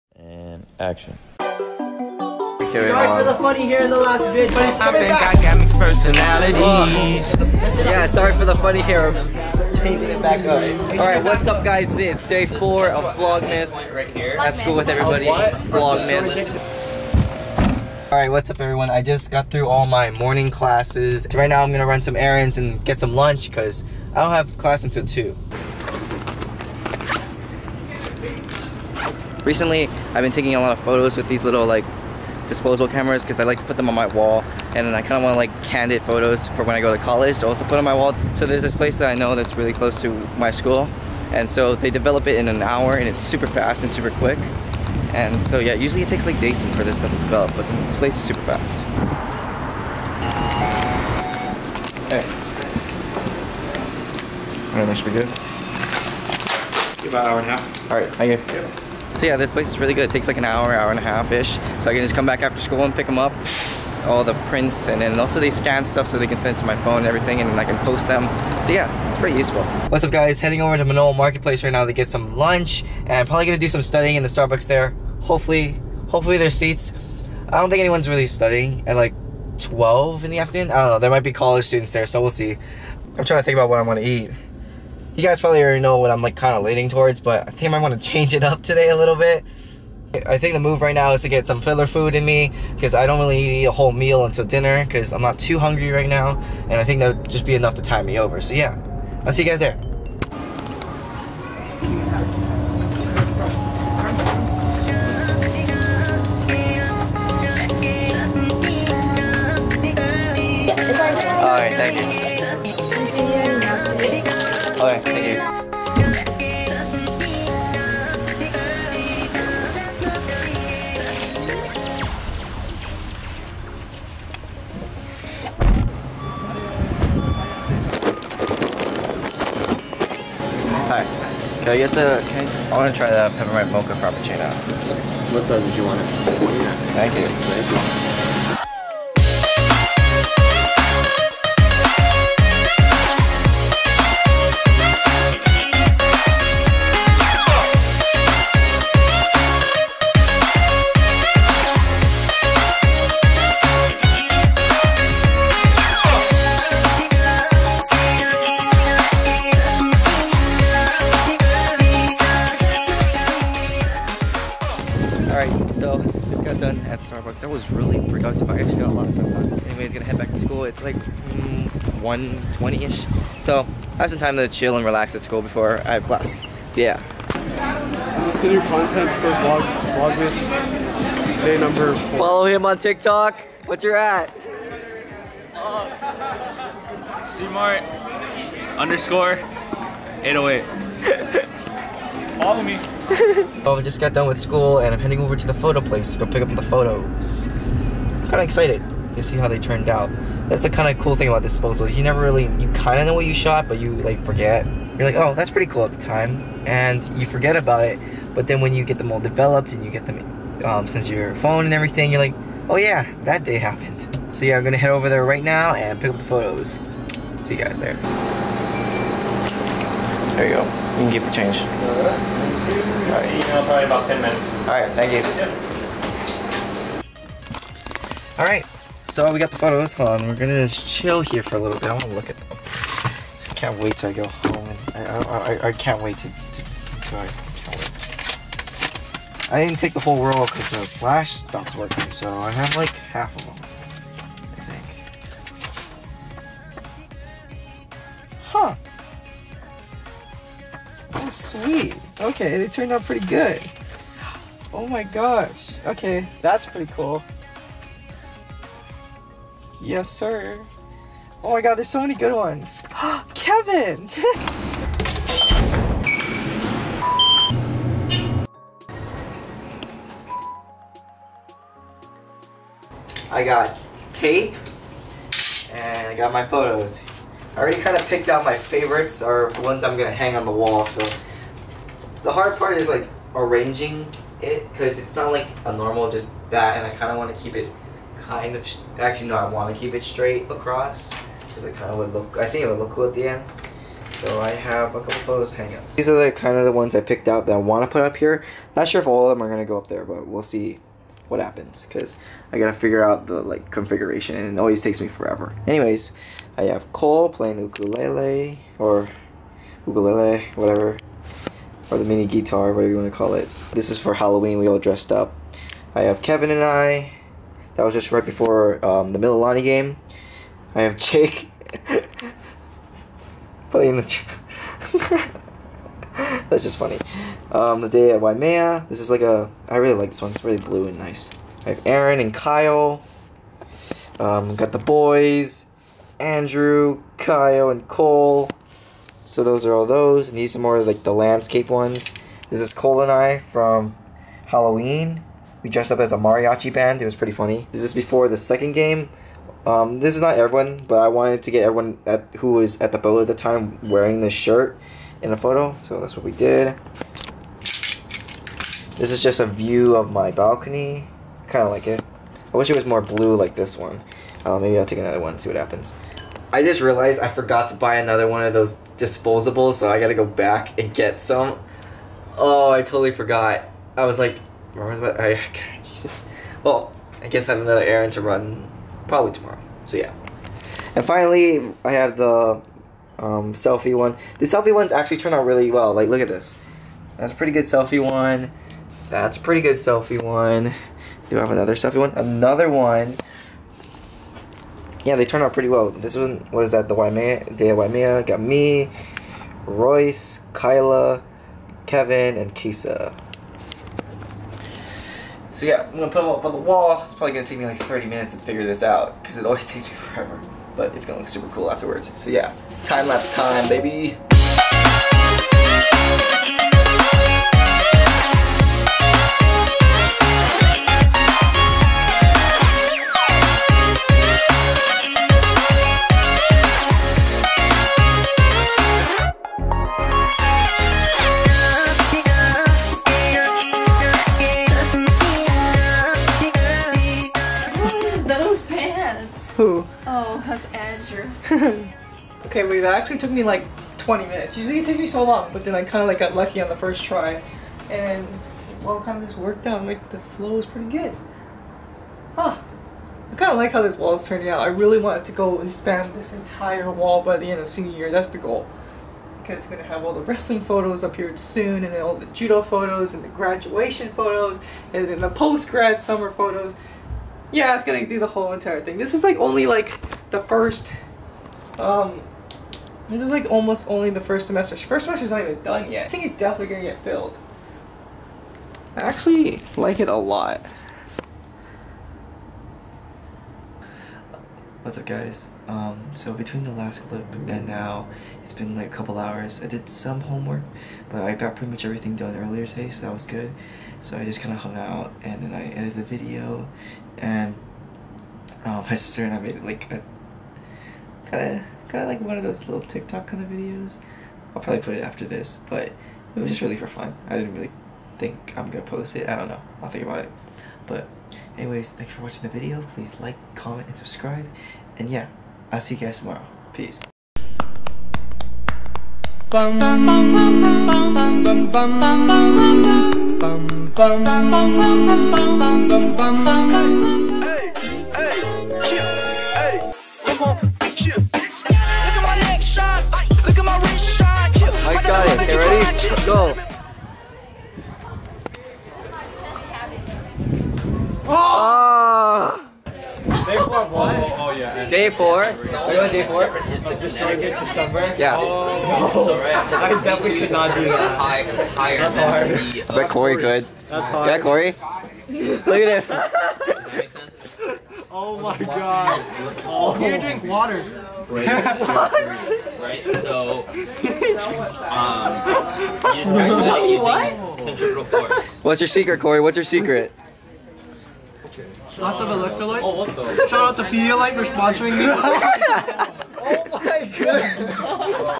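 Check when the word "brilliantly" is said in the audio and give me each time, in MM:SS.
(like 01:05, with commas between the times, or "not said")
not said.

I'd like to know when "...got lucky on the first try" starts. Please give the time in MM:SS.
07:26.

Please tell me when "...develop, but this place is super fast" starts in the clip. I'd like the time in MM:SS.
00:47.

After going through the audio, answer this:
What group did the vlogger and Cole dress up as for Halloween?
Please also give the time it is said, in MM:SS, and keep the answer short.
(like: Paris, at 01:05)
A mariachi band, at 05:46.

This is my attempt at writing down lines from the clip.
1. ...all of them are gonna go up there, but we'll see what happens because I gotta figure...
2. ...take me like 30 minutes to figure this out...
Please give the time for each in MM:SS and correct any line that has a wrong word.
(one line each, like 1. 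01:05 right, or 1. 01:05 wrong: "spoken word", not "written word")
1. 04:59 right
2. 06:47 right.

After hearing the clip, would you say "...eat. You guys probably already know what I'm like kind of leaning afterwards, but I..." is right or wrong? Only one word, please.
wrong.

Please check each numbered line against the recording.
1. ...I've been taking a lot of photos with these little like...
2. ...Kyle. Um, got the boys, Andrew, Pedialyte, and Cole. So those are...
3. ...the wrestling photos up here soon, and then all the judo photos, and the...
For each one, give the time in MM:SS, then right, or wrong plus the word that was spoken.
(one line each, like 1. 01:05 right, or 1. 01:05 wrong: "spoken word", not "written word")
1. 00:30 right
2. 05:32 wrong: "Kyle", not "Pedialyte"
3. 07:40 right.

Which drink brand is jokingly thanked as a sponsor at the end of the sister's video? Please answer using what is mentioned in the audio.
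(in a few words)
Pedialyte.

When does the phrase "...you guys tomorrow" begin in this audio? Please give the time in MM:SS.
08:35.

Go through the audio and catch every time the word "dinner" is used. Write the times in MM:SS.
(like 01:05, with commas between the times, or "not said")
01:34.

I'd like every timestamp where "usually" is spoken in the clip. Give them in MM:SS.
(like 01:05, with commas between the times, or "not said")
00:45, 07:24.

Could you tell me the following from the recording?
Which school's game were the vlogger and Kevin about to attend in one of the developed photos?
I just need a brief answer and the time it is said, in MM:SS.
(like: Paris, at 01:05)
Mililani, at 05:19.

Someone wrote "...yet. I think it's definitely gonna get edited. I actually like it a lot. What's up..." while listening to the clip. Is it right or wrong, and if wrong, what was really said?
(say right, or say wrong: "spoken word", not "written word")
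wrong: "filled", not "edited".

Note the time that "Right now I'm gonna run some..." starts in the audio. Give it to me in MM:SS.
00:21.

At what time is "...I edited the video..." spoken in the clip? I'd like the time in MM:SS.
08:15.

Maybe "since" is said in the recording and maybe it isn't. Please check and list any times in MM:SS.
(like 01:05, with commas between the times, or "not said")
03:30.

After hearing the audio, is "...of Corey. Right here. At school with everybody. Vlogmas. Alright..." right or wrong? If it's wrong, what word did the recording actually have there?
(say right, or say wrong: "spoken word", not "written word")
wrong: "Vlogmas", not "Corey".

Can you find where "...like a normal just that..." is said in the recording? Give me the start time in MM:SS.
04:45.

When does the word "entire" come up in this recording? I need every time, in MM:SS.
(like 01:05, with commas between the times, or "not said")
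07:36, 07:48.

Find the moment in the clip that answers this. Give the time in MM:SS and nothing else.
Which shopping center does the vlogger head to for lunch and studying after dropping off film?
01:10.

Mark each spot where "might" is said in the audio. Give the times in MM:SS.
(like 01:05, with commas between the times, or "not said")
01:21, 01:27.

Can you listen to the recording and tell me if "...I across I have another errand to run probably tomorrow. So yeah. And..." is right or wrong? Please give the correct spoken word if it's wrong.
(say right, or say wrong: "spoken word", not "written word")
wrong: "guess", not "across".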